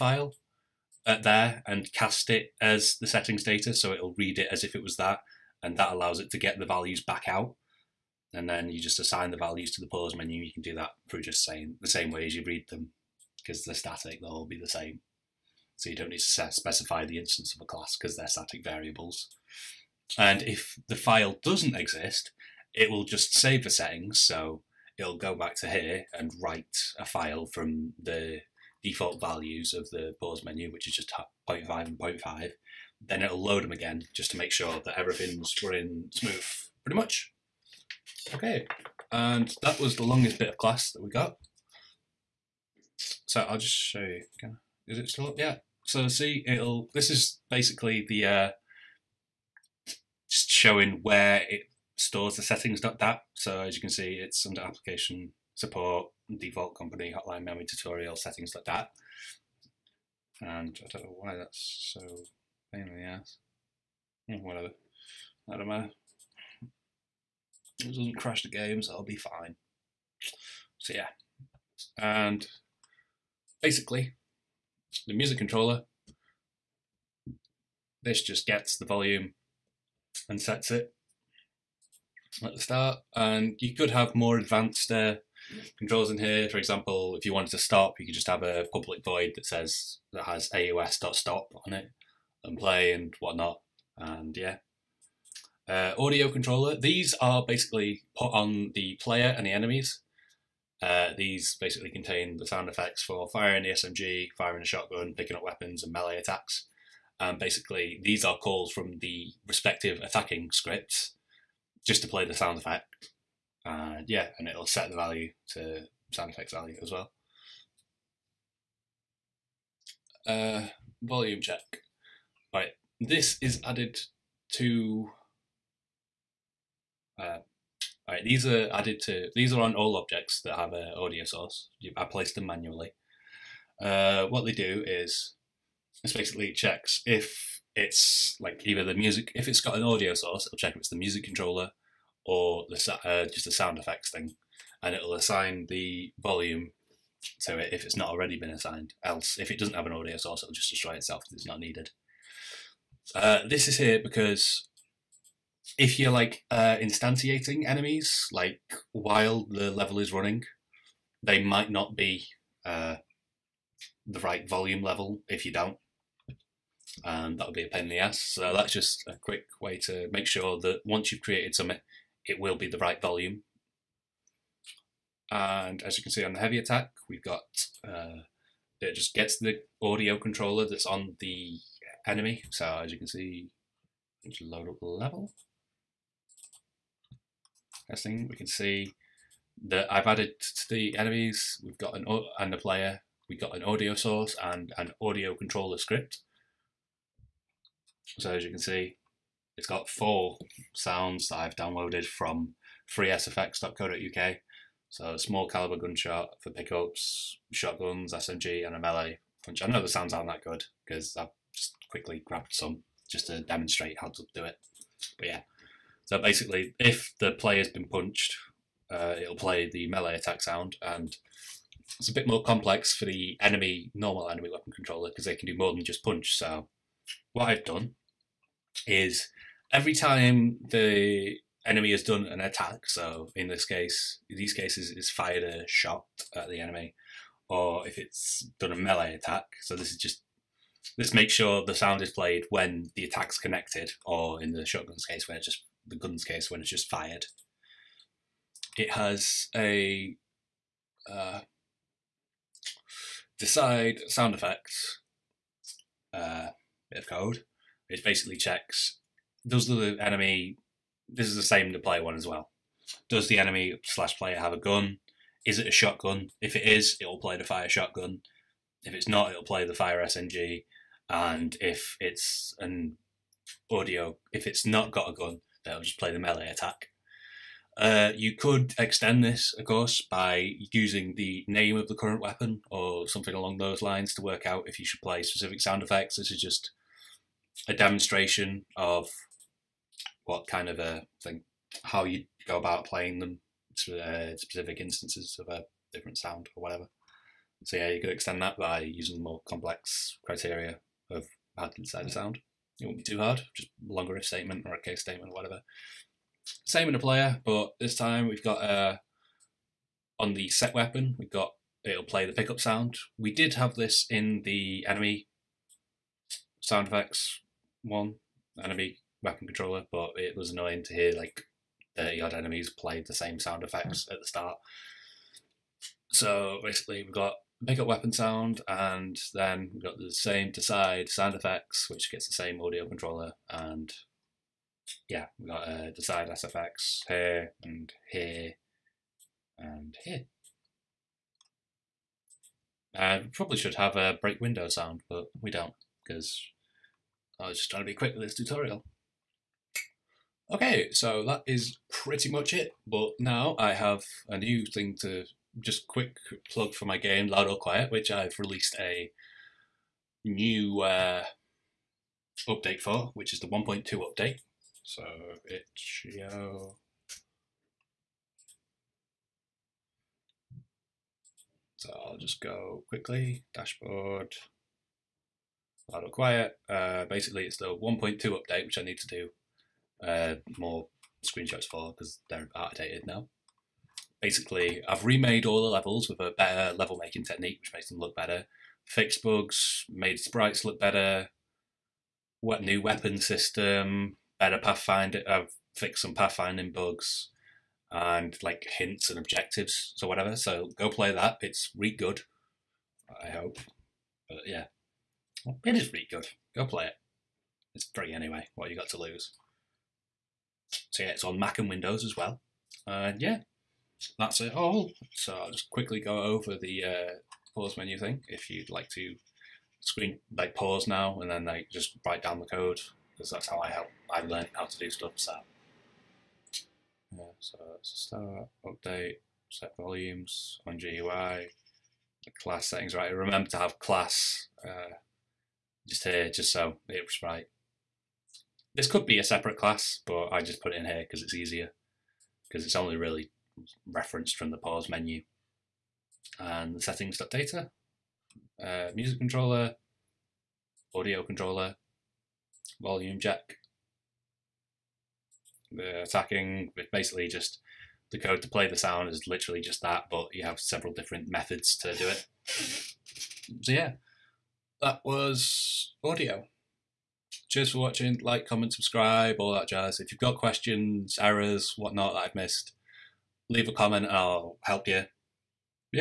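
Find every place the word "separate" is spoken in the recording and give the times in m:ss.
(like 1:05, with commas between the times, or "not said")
7:19.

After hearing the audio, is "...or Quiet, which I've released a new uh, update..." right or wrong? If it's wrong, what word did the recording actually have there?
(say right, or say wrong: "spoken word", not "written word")
right.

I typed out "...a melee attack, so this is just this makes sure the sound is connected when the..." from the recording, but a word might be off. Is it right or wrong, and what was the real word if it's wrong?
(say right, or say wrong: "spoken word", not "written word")
wrong: "played", not "connected".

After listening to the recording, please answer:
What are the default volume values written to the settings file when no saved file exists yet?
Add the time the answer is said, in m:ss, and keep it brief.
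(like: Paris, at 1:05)
0.5 and 0.5, at 0:31.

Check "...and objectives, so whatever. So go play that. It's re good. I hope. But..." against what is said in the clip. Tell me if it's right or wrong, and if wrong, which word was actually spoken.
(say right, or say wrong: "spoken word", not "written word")
right.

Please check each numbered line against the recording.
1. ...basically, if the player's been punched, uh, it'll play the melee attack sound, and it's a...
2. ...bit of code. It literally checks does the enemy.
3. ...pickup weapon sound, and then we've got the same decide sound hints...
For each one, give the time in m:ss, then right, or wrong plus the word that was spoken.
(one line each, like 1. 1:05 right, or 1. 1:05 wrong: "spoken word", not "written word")
1. 3:36 right
2. 4:16 wrong: "basically", not "literally"
3. 5:27 wrong: "effects", not "hints".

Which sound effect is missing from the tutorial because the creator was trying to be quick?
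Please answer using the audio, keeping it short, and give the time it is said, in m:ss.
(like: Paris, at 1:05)
break window sound, at 5:44.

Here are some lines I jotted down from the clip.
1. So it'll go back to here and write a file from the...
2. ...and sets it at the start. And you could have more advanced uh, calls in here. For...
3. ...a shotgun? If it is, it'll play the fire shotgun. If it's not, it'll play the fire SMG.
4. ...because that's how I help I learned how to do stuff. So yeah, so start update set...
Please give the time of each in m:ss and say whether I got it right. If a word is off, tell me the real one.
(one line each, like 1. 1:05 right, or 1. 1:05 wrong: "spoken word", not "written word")
1. 0:24 right
2. 1:20 wrong: "controls", not "calls"
3. 4:25 right
4. 7:03 right.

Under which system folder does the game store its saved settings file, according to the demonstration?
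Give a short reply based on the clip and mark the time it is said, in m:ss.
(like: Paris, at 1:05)
application support, at 0:54.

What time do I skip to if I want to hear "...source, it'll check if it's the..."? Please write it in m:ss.
2:20.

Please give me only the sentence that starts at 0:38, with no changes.
Okay, and that was the longest bit of glass that we got.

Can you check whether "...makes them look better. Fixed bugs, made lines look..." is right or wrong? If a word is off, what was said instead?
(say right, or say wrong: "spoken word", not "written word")
wrong: "sprites", not "lines".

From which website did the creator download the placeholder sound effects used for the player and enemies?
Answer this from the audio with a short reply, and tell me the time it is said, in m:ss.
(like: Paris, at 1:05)
freesfx.co.uk, at 3:22.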